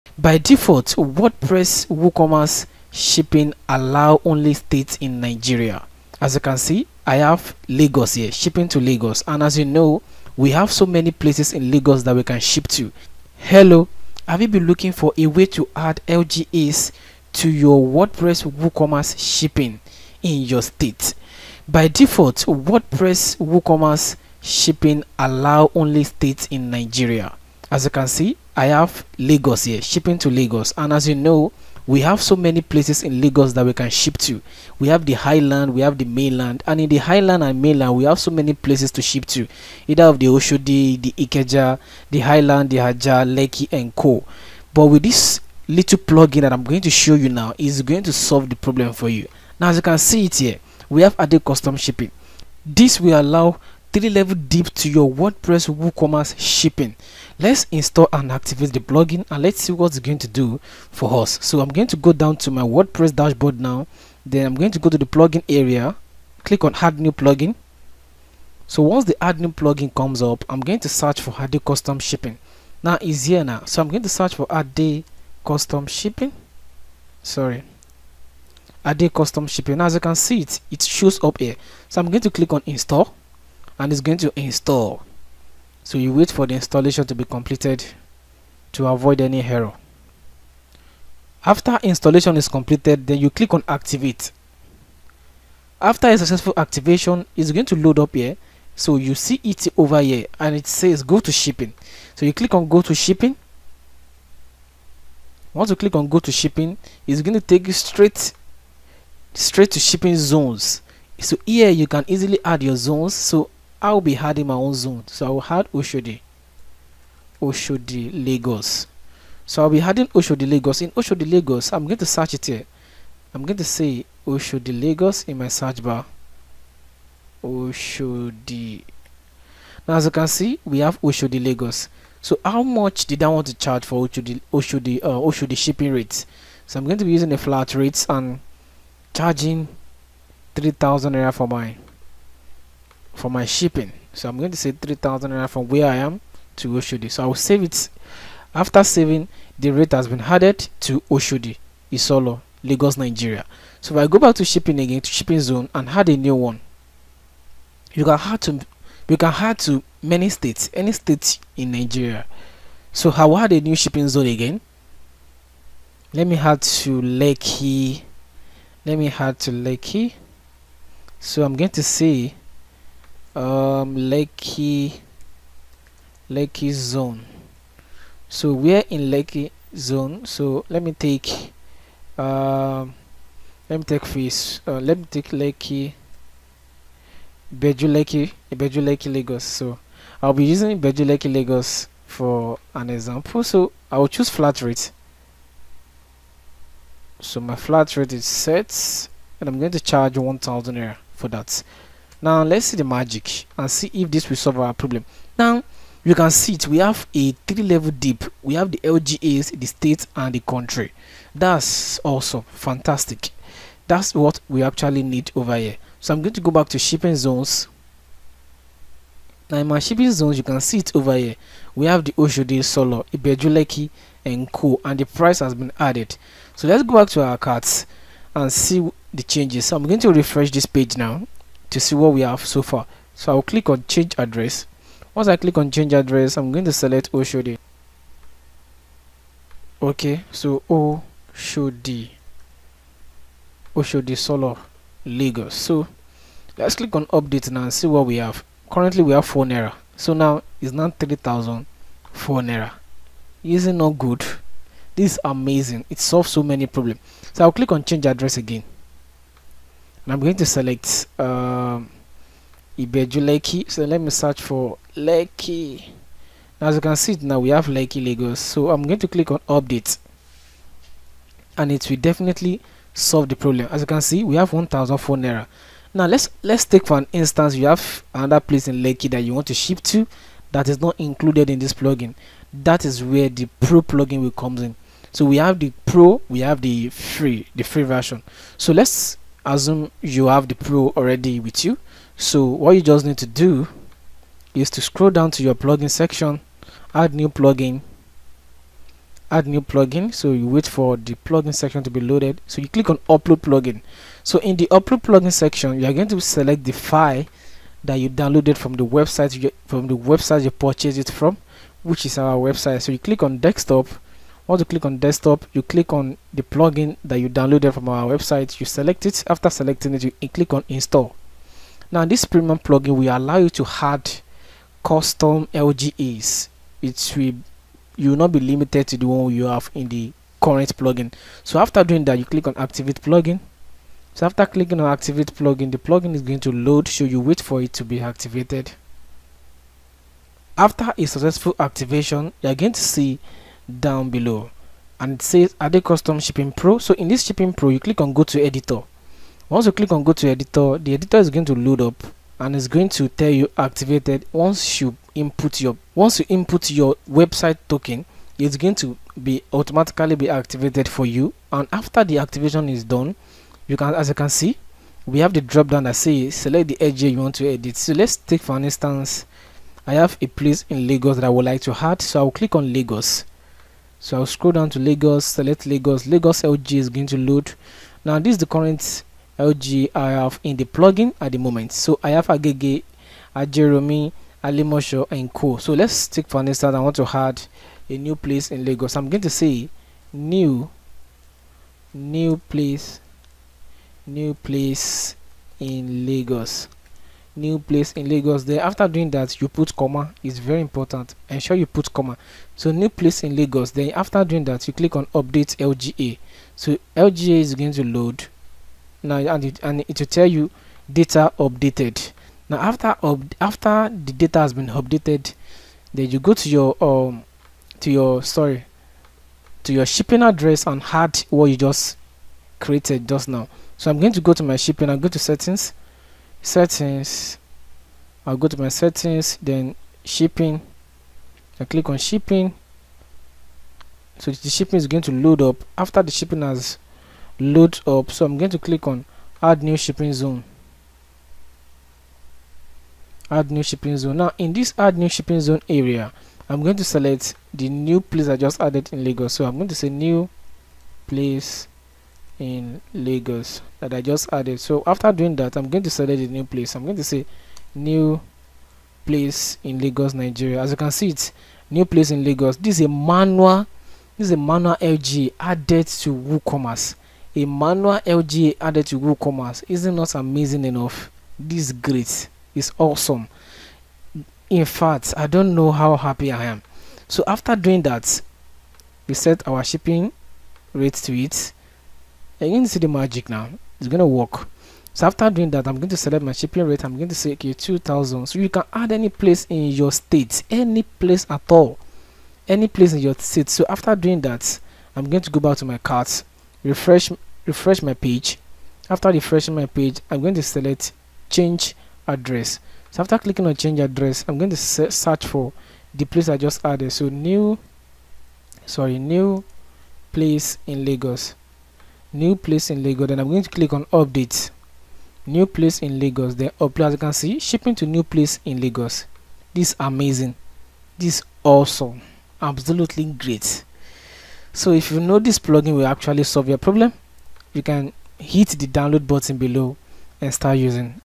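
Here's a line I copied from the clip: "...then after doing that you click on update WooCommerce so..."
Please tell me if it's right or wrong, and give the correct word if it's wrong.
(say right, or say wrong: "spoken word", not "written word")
wrong: "LGA", not "WooCommerce".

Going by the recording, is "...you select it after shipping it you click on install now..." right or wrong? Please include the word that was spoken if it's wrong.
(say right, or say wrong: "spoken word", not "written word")
wrong: "selecting", not "shipping".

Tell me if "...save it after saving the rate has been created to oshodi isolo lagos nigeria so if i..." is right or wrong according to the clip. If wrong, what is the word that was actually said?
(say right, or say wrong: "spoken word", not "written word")
wrong: "added", not "created".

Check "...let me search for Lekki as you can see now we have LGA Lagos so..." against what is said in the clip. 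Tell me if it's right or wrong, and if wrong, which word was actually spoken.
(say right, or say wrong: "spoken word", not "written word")
wrong: "Lekki", not "LGA".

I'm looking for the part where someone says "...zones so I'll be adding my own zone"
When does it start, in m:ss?
1:52.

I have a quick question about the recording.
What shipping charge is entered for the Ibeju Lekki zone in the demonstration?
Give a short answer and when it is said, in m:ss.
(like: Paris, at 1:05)
1000, at 3:20.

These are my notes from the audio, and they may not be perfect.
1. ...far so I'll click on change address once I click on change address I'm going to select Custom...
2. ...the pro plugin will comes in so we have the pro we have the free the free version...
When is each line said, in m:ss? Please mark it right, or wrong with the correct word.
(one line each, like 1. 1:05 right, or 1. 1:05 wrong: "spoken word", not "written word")
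1. 3:52 wrong: "Oshodi", not "Custom"
2. 4:43 right.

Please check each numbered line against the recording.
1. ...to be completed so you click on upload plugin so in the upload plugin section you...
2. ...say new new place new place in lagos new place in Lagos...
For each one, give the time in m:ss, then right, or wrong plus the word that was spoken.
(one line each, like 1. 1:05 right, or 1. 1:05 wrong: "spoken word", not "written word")
1. 5:01 wrong: "loaded", not "completed"
2. 6:29 right.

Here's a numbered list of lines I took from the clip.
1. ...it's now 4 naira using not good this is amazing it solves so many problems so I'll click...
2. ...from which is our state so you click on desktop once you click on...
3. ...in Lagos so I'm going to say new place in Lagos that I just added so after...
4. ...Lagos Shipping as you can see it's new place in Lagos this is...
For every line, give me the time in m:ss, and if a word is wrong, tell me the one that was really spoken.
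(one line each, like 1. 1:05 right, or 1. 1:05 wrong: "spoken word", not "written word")
1. 4:10 right
2. 5:11 wrong: "website", not "state"
3. 7:28 right
4. 7:39 wrong: "Nigeria", not "Shipping".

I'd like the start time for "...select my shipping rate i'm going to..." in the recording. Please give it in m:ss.
8:05.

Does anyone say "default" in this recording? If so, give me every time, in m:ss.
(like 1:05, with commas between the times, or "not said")
0:00, 0:21.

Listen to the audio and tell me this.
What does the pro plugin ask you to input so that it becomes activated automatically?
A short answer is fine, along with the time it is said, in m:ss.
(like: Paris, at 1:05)
Website token, at 5:57.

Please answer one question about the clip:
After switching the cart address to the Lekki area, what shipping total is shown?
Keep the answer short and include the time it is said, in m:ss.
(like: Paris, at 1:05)
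1004 naira, at 4:34.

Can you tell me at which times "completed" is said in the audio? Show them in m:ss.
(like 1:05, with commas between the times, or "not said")
1:27, 1:32.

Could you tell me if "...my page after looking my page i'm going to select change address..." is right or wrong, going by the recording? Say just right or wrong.
wrong.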